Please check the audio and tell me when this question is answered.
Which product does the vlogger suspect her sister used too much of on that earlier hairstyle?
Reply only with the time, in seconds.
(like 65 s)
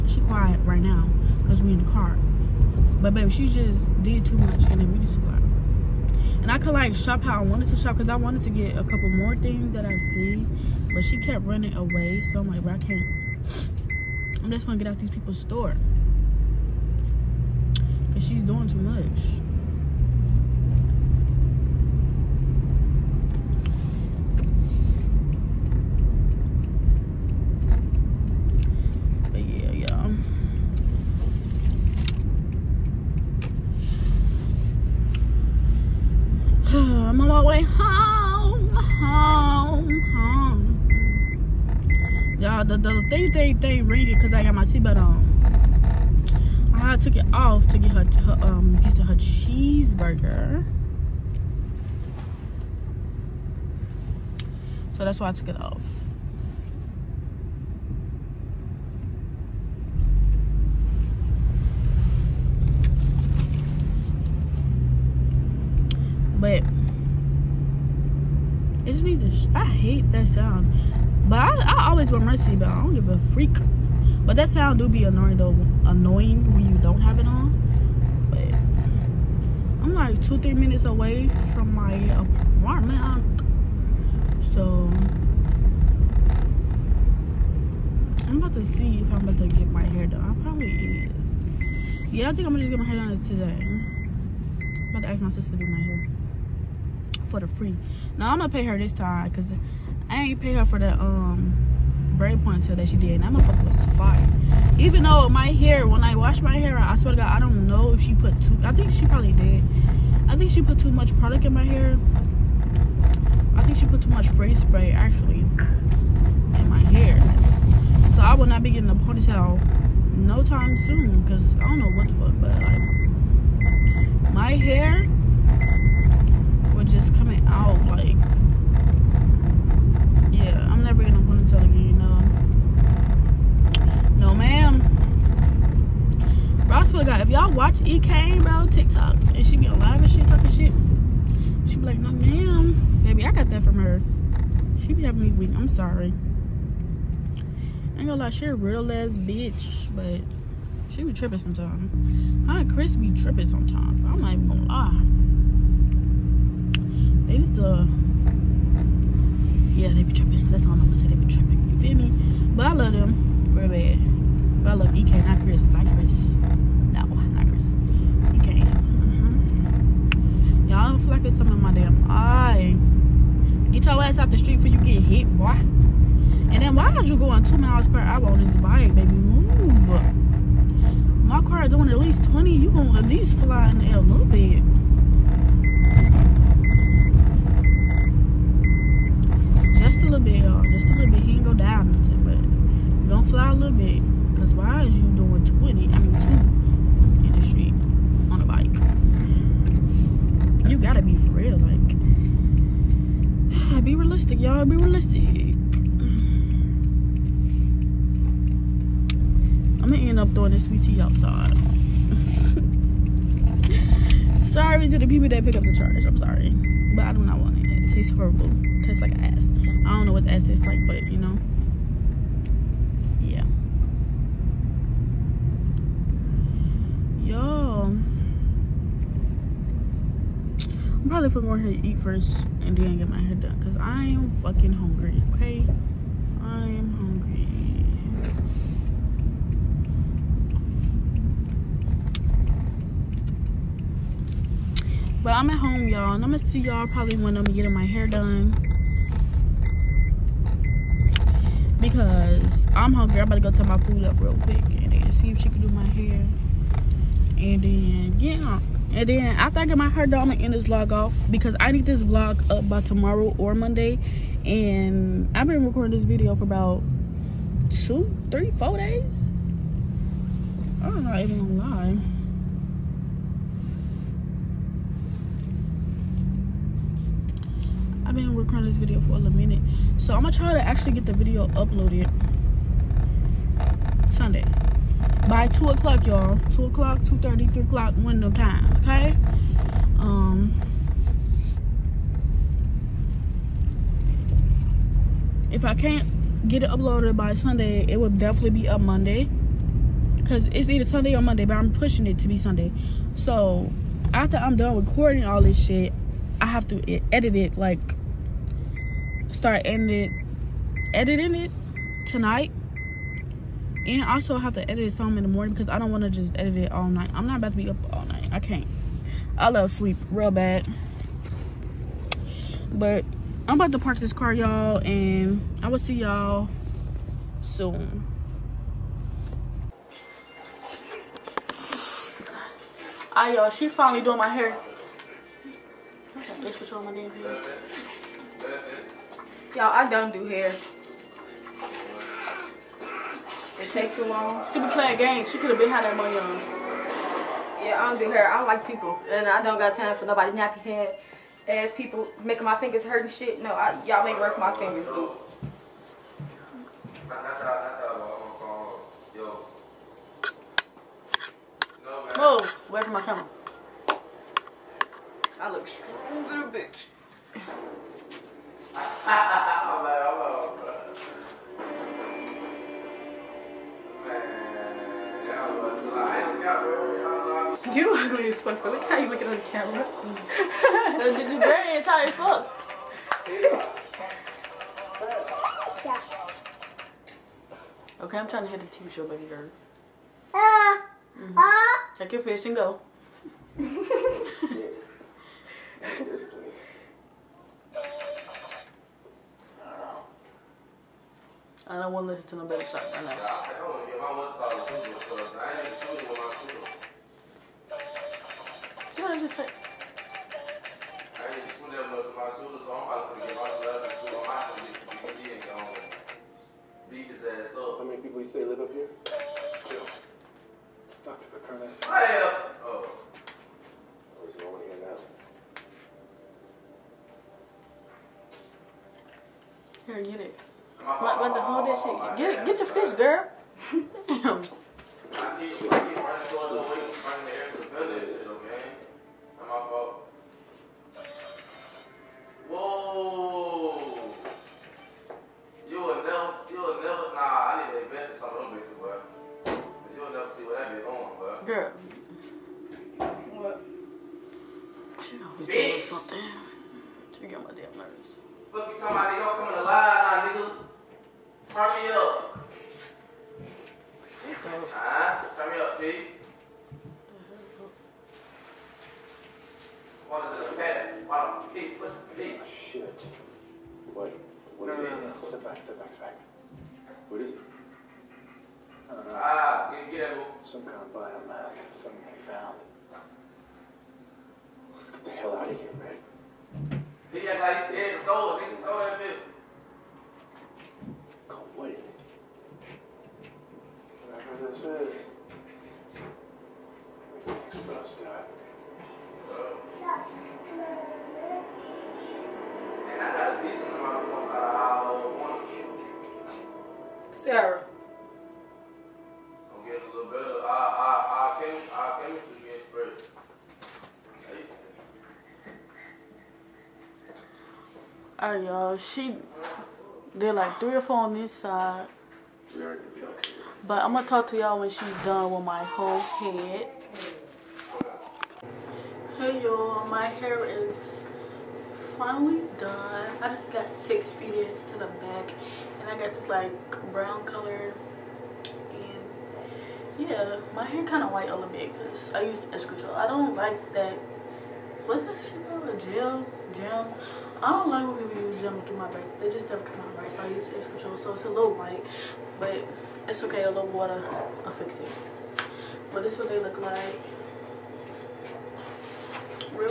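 114 s.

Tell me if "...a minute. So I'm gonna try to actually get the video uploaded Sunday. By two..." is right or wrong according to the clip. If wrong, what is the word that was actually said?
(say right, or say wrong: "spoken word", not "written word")
right.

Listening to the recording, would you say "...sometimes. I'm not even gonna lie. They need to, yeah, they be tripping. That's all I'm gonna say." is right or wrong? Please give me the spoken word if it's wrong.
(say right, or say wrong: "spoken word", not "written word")
right.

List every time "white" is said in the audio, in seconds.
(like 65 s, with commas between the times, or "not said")
541 s, 551 s.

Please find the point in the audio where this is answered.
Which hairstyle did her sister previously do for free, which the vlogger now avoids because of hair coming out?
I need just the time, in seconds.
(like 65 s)
102 s.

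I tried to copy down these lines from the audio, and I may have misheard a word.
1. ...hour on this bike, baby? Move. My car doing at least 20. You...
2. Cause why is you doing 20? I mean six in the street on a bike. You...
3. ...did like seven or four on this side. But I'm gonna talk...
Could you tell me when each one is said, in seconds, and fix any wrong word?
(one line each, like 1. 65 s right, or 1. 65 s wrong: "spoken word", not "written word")
1. 177 s right
2. 194 s wrong: "two", not "six"
3. 520 s wrong: "three", not "seven".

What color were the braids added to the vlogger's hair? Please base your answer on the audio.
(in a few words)
brown.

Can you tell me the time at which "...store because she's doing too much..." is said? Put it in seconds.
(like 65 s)
15 s.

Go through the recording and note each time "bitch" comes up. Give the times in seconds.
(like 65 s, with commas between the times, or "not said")
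149 s, 336 s, 366 s.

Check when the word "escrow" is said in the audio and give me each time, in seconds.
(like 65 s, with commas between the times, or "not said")
542 s, 550 s.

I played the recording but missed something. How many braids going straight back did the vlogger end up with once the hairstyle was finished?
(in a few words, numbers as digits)
6.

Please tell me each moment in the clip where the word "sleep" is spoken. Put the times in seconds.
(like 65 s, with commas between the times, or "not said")
319 s.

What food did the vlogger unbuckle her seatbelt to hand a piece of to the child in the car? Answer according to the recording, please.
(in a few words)
cheeseburger.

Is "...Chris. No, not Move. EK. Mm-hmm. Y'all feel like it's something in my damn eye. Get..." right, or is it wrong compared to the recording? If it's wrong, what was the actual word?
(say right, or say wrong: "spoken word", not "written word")
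wrong: "Chris", not "Move".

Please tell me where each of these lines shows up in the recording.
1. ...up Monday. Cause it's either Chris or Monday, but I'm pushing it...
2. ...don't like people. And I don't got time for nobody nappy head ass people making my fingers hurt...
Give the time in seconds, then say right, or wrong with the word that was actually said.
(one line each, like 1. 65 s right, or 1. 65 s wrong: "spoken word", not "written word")
1. 298 s wrong: "Sunday", not "Chris"
2. 348 s right.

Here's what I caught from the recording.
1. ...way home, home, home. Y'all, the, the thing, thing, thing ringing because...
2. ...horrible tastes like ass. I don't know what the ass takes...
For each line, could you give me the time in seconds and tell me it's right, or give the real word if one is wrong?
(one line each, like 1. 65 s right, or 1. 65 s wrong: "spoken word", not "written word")
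1. 37 s right
2. 218 s wrong: "tastes", not "takes".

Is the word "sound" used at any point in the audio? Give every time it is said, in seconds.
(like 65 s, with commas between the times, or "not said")
70 s, 74 s.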